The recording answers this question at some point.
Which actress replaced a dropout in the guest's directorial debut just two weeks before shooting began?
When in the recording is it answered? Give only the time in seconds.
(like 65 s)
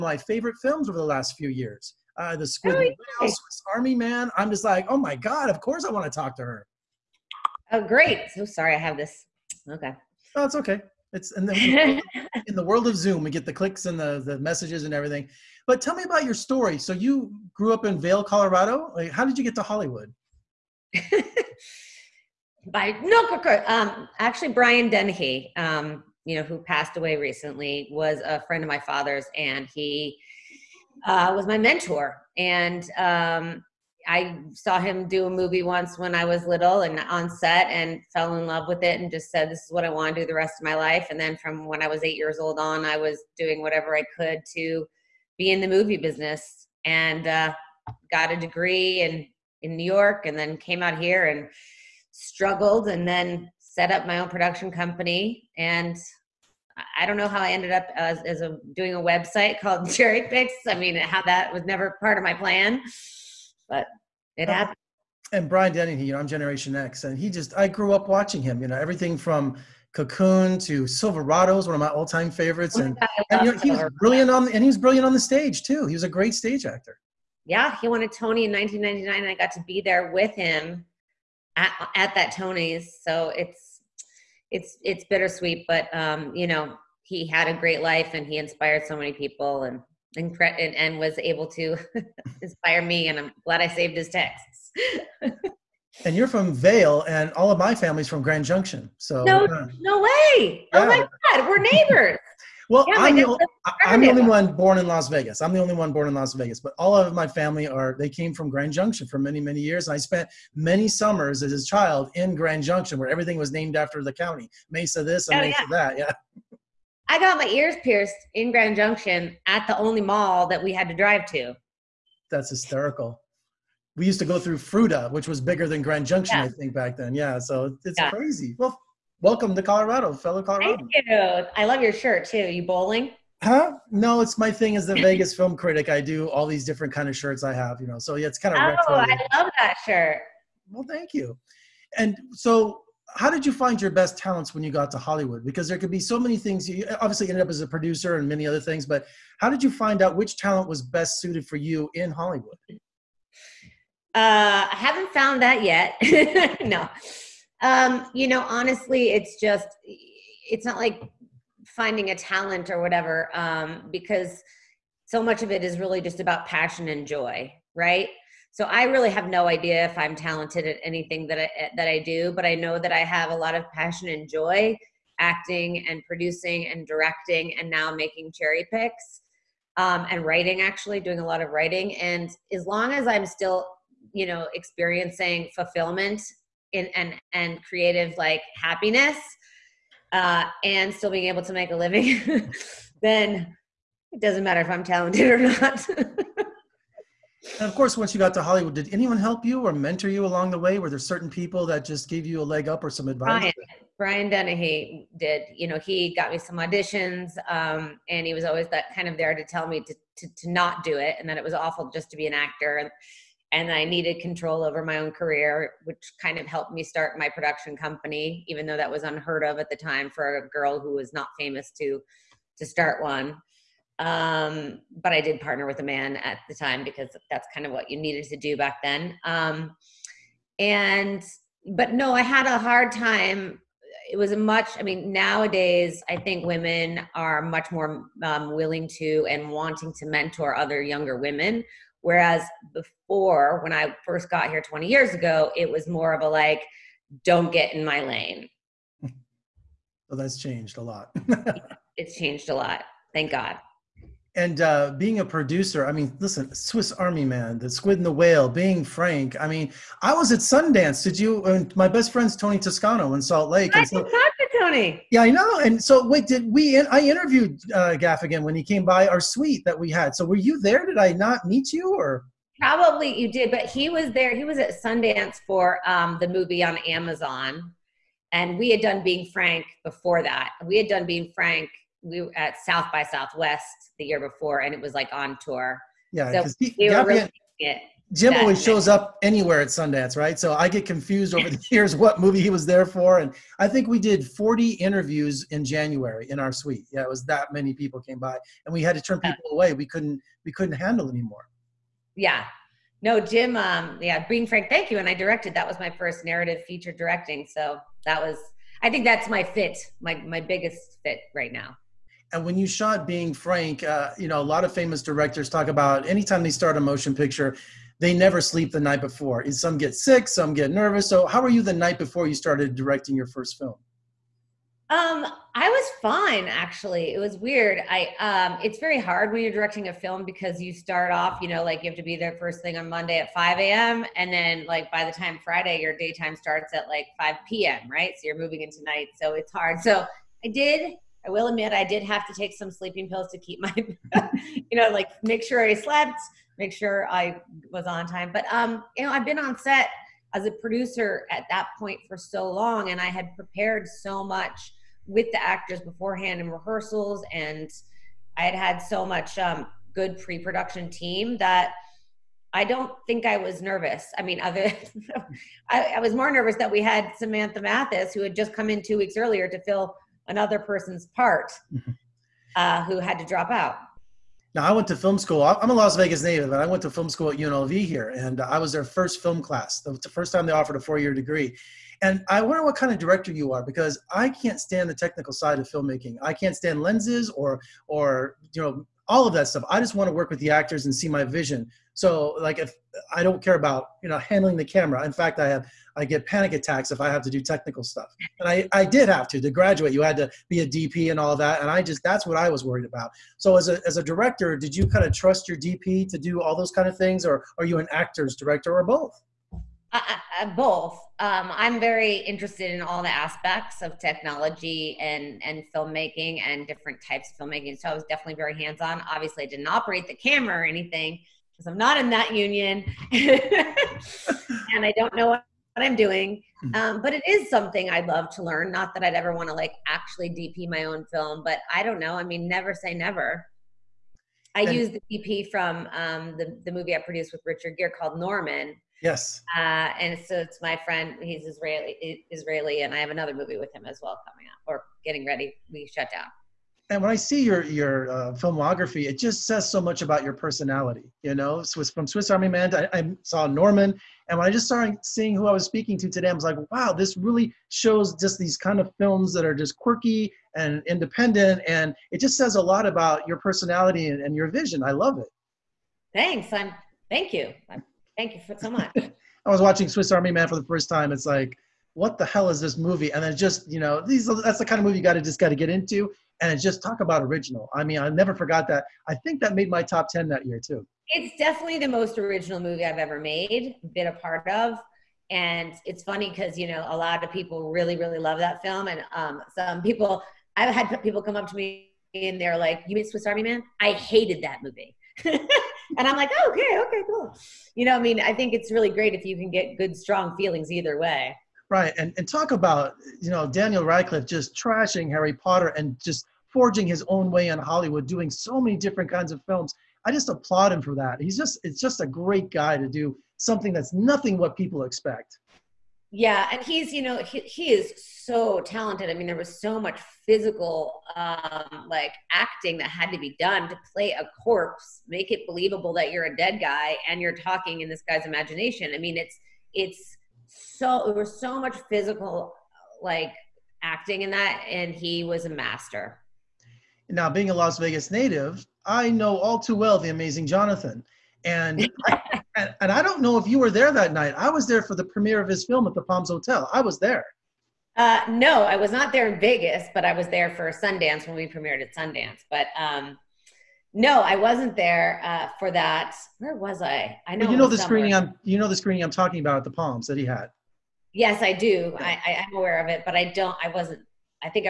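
367 s.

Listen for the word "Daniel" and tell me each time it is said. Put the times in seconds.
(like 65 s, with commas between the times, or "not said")
503 s.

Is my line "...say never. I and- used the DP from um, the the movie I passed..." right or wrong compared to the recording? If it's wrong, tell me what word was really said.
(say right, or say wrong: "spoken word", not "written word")
wrong: "produced", not "passed".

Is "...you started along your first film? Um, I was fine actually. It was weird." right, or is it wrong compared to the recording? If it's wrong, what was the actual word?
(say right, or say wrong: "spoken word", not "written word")
wrong: "directing", not "along".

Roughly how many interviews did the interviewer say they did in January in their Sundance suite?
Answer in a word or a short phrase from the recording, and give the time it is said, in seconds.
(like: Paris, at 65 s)
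40, at 294 s.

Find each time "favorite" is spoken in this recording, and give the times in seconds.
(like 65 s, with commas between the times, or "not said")
0 s, 72 s.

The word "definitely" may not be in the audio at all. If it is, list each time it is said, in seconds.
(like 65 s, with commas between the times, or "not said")
418 s, 481 s.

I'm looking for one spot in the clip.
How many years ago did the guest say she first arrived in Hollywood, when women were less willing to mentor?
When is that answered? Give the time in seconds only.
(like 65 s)
244 s.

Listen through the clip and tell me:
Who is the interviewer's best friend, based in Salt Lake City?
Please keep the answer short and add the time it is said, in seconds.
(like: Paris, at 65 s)
Tony Toscano, at 262 s.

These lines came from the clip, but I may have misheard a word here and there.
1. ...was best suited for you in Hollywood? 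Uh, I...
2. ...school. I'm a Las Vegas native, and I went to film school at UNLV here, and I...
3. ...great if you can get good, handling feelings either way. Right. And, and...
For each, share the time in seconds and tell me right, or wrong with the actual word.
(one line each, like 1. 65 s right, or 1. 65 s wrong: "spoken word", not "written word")
1. 150 s right
2. 375 s right
3. 498 s wrong: "strong", not "handling".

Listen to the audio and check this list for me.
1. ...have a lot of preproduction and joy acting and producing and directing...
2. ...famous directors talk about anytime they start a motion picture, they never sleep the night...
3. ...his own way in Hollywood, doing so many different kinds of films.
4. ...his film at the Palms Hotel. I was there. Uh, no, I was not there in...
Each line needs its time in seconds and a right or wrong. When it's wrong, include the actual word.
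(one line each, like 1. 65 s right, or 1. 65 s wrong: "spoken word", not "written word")
1. 172 s wrong: "passion", not "preproduction"
2. 314 s right
3. 506 s right
4. 545 s right.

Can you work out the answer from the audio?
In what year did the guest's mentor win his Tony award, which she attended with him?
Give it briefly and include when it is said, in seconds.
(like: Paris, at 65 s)
1999, at 78 s.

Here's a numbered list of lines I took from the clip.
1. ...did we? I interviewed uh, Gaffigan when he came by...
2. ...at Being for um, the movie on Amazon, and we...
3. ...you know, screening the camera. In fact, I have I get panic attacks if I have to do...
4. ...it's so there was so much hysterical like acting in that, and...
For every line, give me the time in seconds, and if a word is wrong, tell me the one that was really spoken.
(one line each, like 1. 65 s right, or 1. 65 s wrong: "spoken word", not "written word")
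1. 266 s right
2. 274 s wrong: "Sundance", not "Being"
3. 394 s wrong: "handling", not "screening"
4. 529 s wrong: "physical", not "hysterical".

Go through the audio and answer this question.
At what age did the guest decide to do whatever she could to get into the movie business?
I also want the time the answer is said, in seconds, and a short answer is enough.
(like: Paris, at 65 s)
8, at 42 s.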